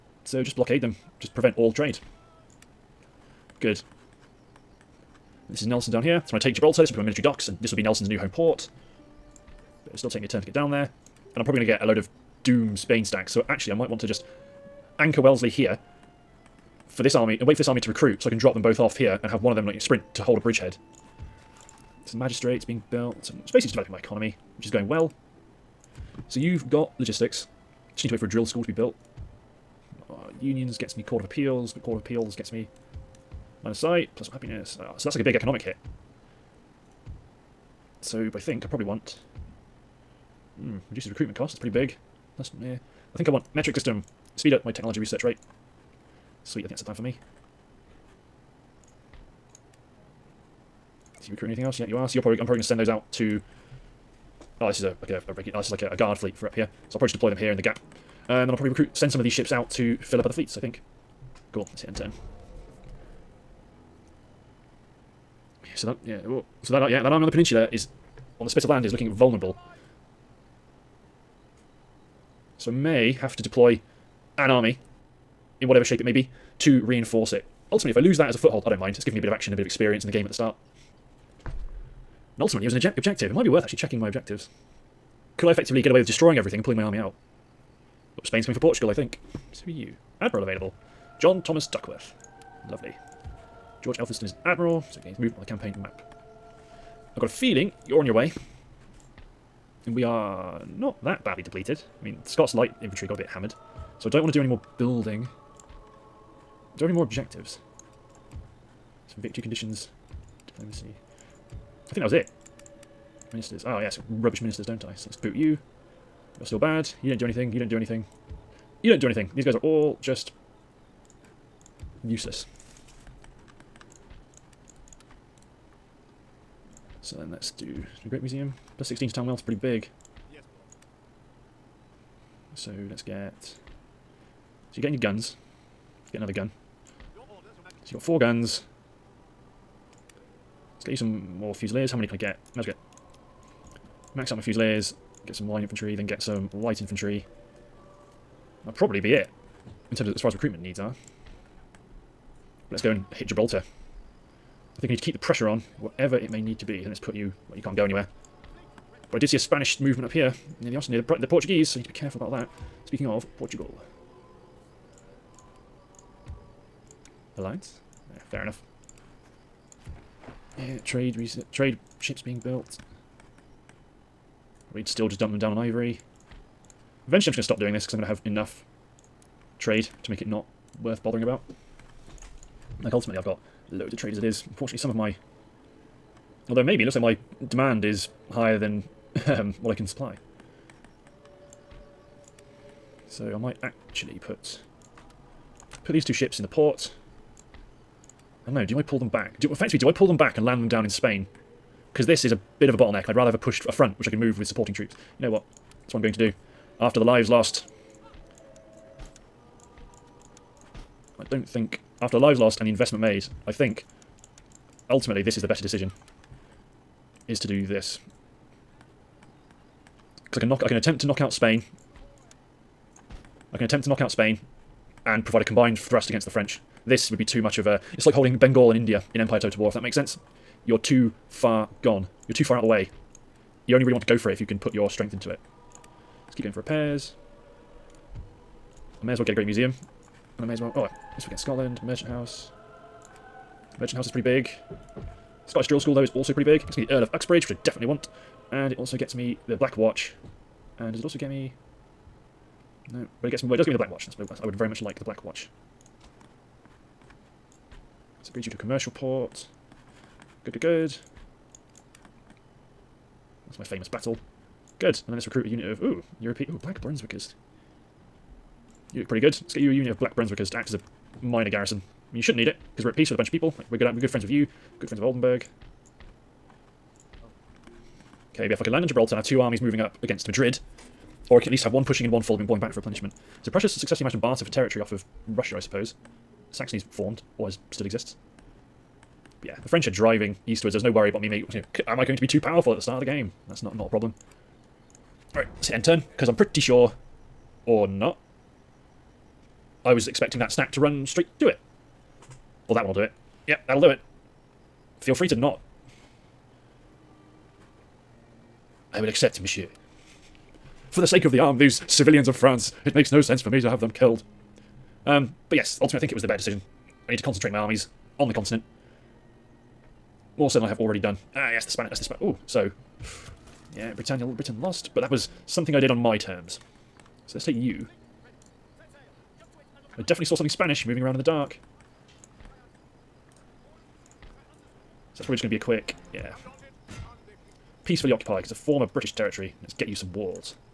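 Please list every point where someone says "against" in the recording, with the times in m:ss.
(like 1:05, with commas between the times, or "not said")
3:46, 4:40.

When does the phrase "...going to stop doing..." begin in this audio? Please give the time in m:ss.
2:57.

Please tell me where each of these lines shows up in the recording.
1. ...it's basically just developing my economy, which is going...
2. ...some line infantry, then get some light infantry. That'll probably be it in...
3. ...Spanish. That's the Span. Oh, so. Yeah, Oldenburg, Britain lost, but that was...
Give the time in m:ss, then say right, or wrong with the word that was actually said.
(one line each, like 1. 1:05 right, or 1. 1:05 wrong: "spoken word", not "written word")
1. 0:23 right
2. 2:25 right
3. 5:21 wrong: "Britannia", not "Oldenburg".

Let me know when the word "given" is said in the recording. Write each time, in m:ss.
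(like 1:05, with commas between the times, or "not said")
1:19.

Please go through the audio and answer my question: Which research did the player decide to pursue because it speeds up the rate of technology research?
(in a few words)
Metric system.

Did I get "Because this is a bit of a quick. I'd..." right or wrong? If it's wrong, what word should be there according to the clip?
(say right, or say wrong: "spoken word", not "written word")
wrong: "bottleneck", not "quick".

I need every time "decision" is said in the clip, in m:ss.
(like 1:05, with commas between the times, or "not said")
3:35, 5:16.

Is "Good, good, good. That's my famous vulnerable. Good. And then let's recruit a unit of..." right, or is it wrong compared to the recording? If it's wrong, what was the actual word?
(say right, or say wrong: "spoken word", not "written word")
wrong: "battle", not "vulnerable".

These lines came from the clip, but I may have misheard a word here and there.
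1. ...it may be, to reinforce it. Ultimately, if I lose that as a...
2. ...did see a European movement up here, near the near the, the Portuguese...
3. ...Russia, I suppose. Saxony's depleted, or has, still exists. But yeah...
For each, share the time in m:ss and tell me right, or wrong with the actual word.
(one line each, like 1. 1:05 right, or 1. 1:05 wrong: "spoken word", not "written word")
1. 1:15 right
2. 2:39 wrong: "Spanish", not "European"
3. 4:45 wrong: "formed", not "depleted".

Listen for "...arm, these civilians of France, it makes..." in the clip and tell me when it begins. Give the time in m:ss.
5:11.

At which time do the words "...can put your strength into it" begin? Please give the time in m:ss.
3:54.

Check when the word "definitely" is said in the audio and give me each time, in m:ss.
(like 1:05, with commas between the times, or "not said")
4:07, 5:30.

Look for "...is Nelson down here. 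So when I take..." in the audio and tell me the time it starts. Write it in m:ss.
0:05.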